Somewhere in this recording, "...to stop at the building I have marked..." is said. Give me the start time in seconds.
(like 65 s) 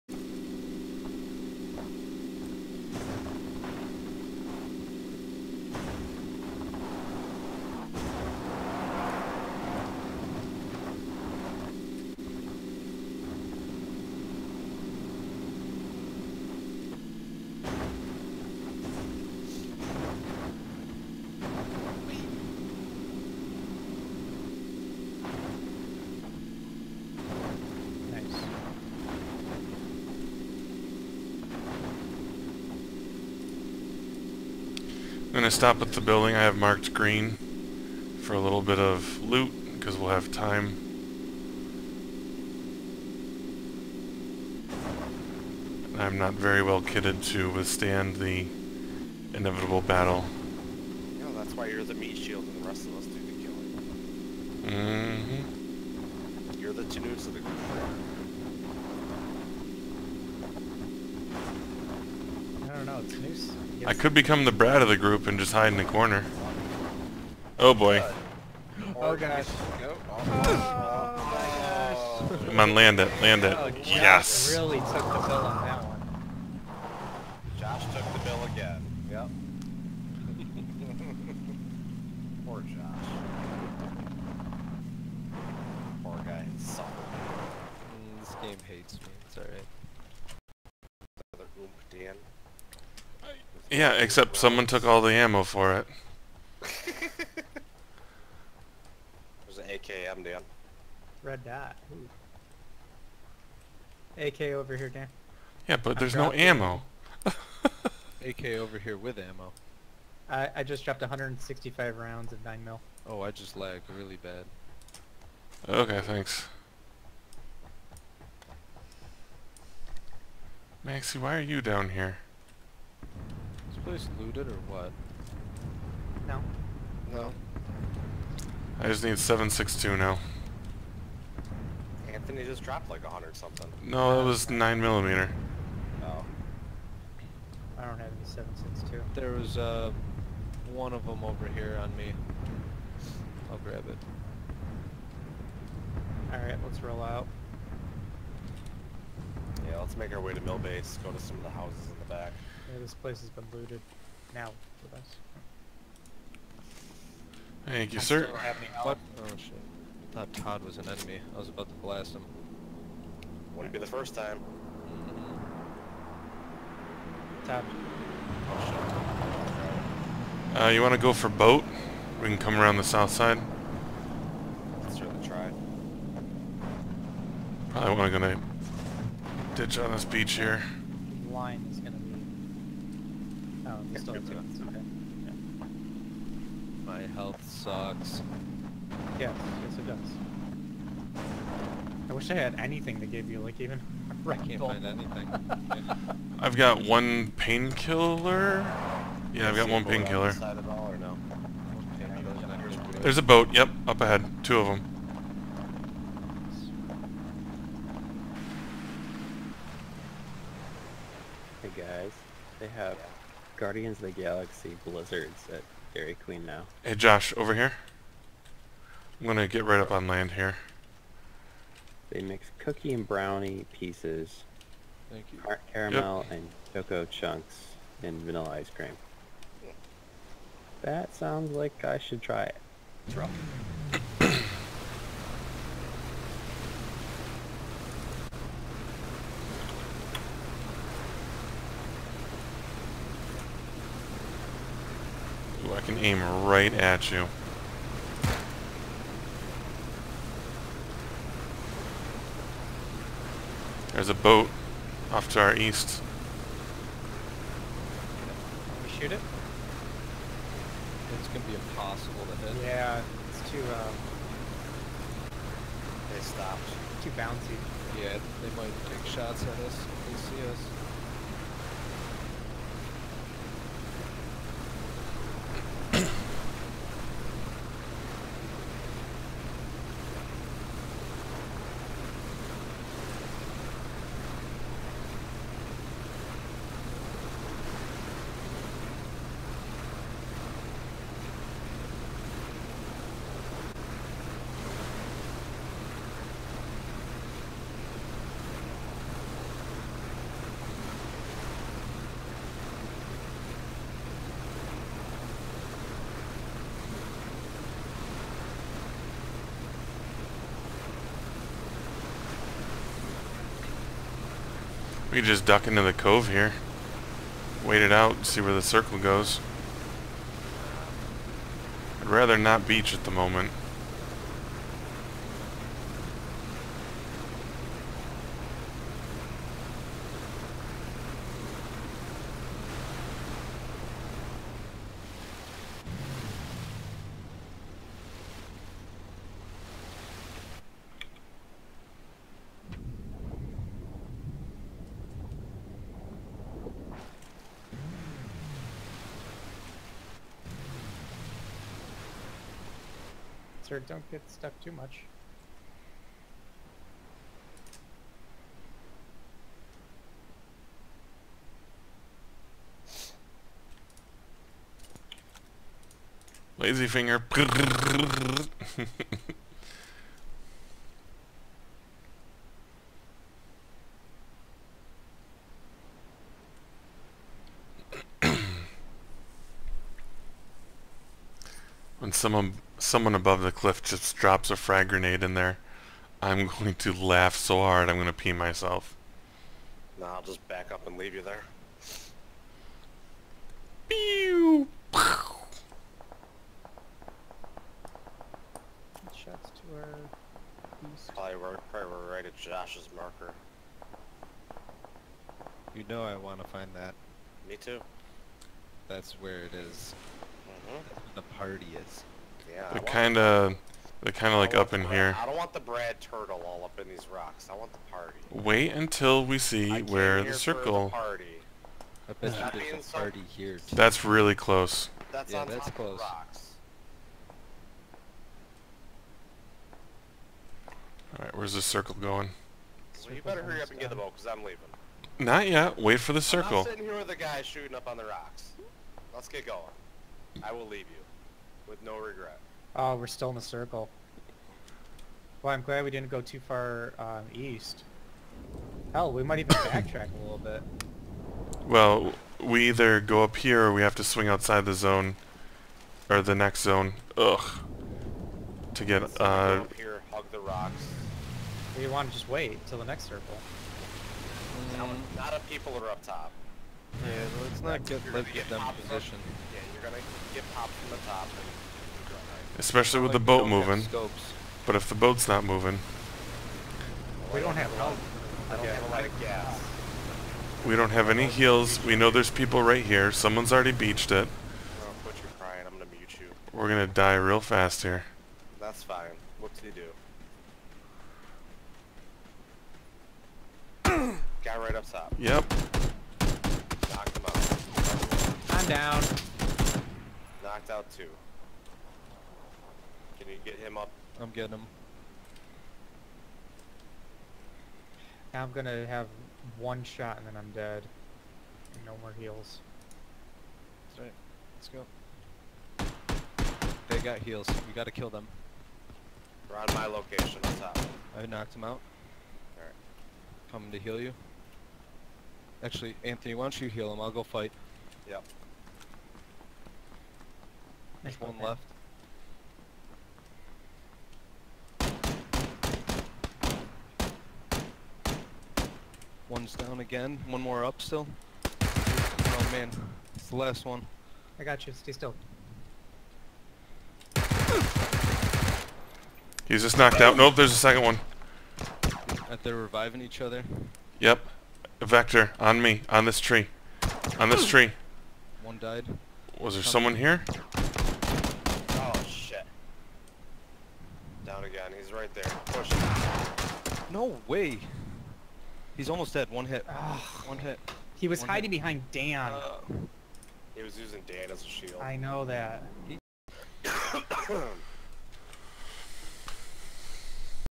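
35 s.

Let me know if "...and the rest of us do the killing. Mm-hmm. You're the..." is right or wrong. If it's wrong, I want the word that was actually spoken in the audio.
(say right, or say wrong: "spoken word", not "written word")
right.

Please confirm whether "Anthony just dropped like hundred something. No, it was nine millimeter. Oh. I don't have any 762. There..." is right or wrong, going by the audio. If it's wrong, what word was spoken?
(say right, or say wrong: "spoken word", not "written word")
right.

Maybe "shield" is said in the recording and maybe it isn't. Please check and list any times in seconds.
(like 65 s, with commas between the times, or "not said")
52 s, 574 s.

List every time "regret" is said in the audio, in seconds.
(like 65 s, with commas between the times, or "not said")
441 s.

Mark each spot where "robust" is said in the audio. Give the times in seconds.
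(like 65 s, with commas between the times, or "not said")
not said.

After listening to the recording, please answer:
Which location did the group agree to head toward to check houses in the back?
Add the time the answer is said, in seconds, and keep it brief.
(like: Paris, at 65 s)
Mill Base, at 150 s.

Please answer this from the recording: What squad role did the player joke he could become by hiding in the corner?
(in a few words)
the brat.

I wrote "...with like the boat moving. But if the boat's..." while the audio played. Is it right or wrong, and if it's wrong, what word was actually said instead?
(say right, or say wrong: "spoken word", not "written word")
right.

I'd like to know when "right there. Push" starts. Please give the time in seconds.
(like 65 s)
564 s.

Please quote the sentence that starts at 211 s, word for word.
Hey guys, they have Guardians of the Galaxy Blizzards at Dairy Queen now.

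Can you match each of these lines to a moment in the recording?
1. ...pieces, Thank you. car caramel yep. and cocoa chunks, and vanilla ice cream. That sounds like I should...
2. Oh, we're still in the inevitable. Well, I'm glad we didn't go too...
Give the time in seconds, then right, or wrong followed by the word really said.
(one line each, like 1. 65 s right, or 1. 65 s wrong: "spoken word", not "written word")
1. 223 s right
2. 442 s wrong: "circle", not "inevitable".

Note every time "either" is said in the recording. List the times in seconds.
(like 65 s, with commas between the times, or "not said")
452 s.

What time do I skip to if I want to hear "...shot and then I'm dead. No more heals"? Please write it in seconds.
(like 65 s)
509 s.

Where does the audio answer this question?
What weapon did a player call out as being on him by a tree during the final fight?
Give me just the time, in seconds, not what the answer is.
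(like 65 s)
554 s.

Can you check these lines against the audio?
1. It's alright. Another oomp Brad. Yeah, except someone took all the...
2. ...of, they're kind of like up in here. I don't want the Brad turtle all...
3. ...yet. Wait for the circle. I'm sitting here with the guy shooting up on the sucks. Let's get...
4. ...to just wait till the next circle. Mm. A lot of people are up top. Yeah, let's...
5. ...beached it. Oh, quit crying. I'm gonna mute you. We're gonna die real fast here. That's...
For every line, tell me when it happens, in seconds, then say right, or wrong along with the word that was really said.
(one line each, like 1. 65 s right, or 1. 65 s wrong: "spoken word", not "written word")
1. 89 s wrong: "Dan", not "Brad"
2. 413 s right
3. 435 s wrong: "rocks", not "sucks"
4. 462 s right
5. 483 s right.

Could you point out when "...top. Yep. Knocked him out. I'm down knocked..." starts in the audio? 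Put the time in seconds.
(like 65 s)
494 s.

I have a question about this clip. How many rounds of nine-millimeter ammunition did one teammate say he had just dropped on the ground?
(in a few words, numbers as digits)
165.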